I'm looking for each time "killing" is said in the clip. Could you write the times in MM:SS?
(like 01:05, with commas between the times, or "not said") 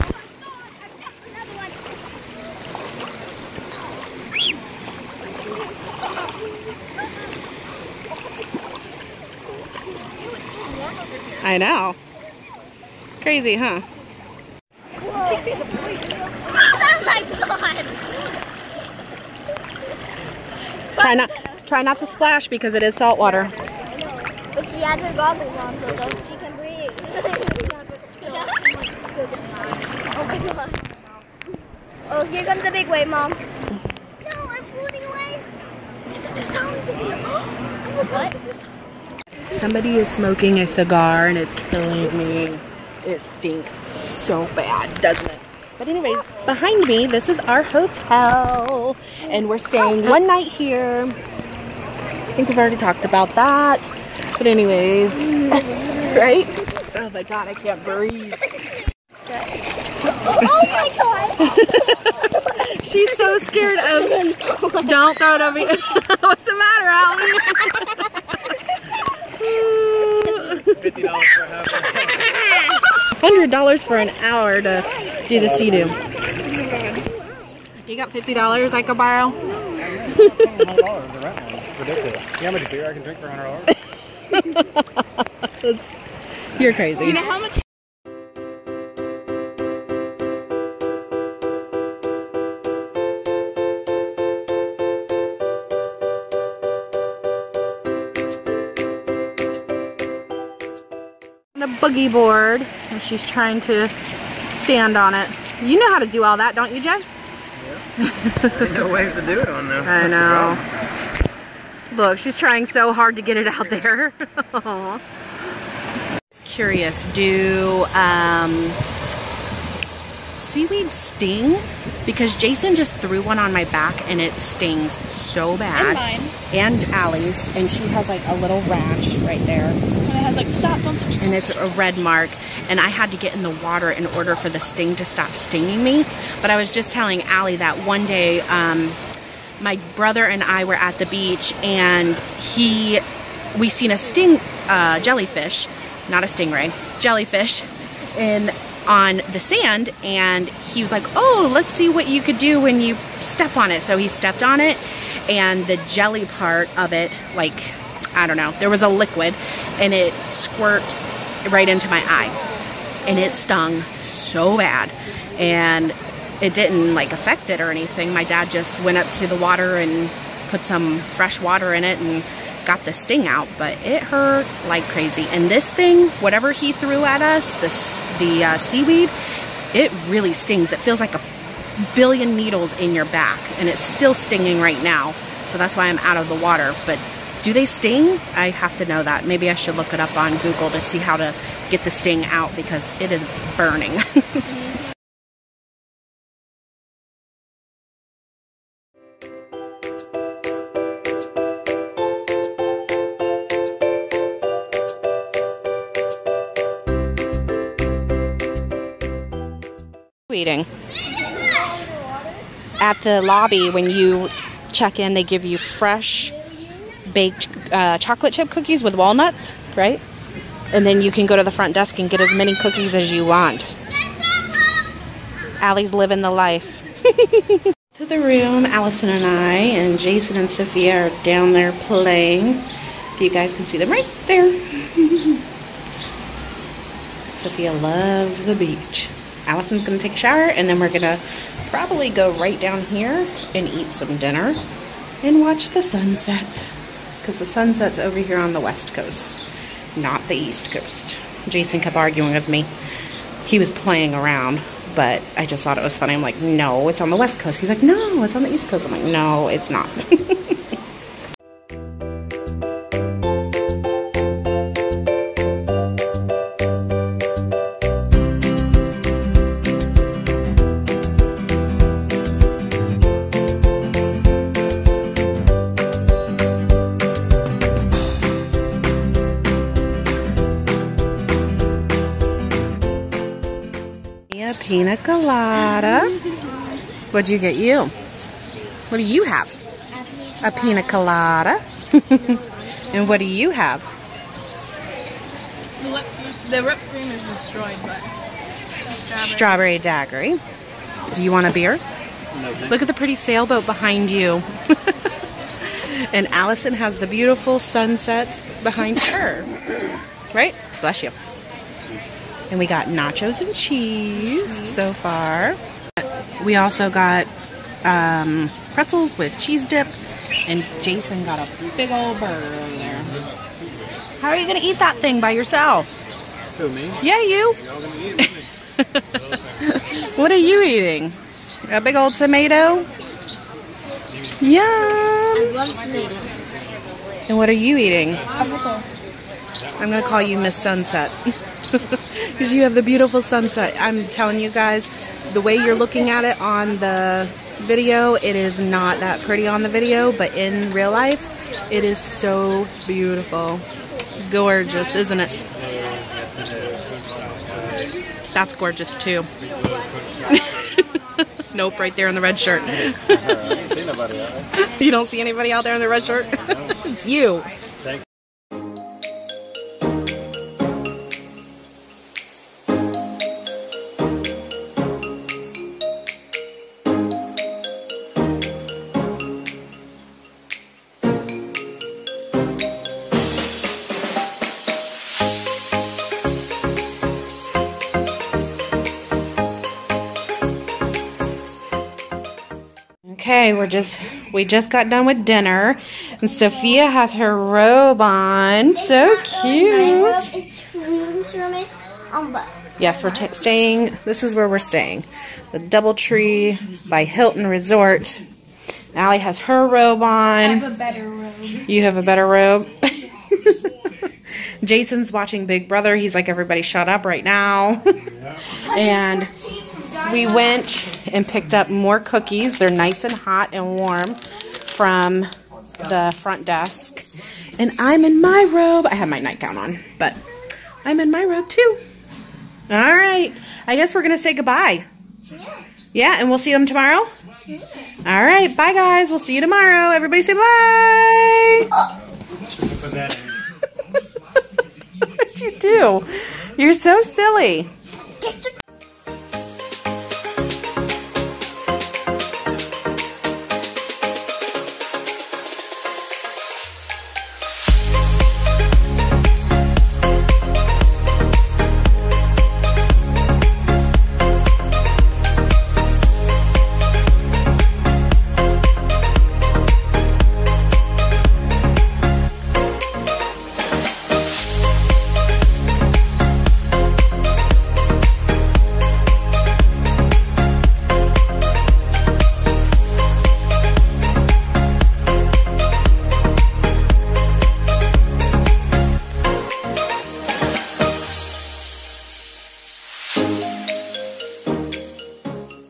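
00:41.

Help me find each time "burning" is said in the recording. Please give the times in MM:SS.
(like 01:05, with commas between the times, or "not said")
03:13.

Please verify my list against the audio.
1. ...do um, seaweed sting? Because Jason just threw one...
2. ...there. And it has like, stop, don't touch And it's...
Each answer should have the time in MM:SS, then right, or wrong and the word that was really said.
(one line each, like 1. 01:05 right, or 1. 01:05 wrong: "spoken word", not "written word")
1. 01:57 right
2. 02:09 right.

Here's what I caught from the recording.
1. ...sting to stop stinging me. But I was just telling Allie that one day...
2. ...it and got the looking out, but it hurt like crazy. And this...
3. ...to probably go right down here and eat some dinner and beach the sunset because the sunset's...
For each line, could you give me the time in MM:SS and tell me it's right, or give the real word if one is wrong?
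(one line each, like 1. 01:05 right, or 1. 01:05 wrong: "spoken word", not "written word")
1. 02:14 right
2. 02:51 wrong: "sting", not "looking"
3. 04:01 wrong: "watch", not "beach".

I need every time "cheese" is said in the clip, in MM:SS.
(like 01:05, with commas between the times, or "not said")
05:13, 05:19.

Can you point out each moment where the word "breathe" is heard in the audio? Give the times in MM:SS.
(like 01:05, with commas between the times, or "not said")
00:26, 00:57.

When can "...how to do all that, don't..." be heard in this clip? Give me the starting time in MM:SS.
01:45.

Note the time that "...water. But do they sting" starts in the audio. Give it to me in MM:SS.
03:06.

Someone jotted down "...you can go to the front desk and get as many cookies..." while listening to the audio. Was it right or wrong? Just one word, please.
right.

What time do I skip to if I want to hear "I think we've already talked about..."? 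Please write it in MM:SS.
00:51.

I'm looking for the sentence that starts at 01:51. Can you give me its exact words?
Look, she's trying so hard to get it out there.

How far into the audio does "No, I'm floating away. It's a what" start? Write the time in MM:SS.
00:33.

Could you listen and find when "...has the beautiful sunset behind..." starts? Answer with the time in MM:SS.
05:06.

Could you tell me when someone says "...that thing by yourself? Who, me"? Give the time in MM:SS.
05:24.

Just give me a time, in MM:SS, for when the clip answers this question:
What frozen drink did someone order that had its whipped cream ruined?
04:59.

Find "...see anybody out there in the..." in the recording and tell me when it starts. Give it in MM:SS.
06:05.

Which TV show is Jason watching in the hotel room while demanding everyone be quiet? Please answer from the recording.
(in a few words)
Big Brother.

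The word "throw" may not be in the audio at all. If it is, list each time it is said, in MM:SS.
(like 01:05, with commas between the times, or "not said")
01:05.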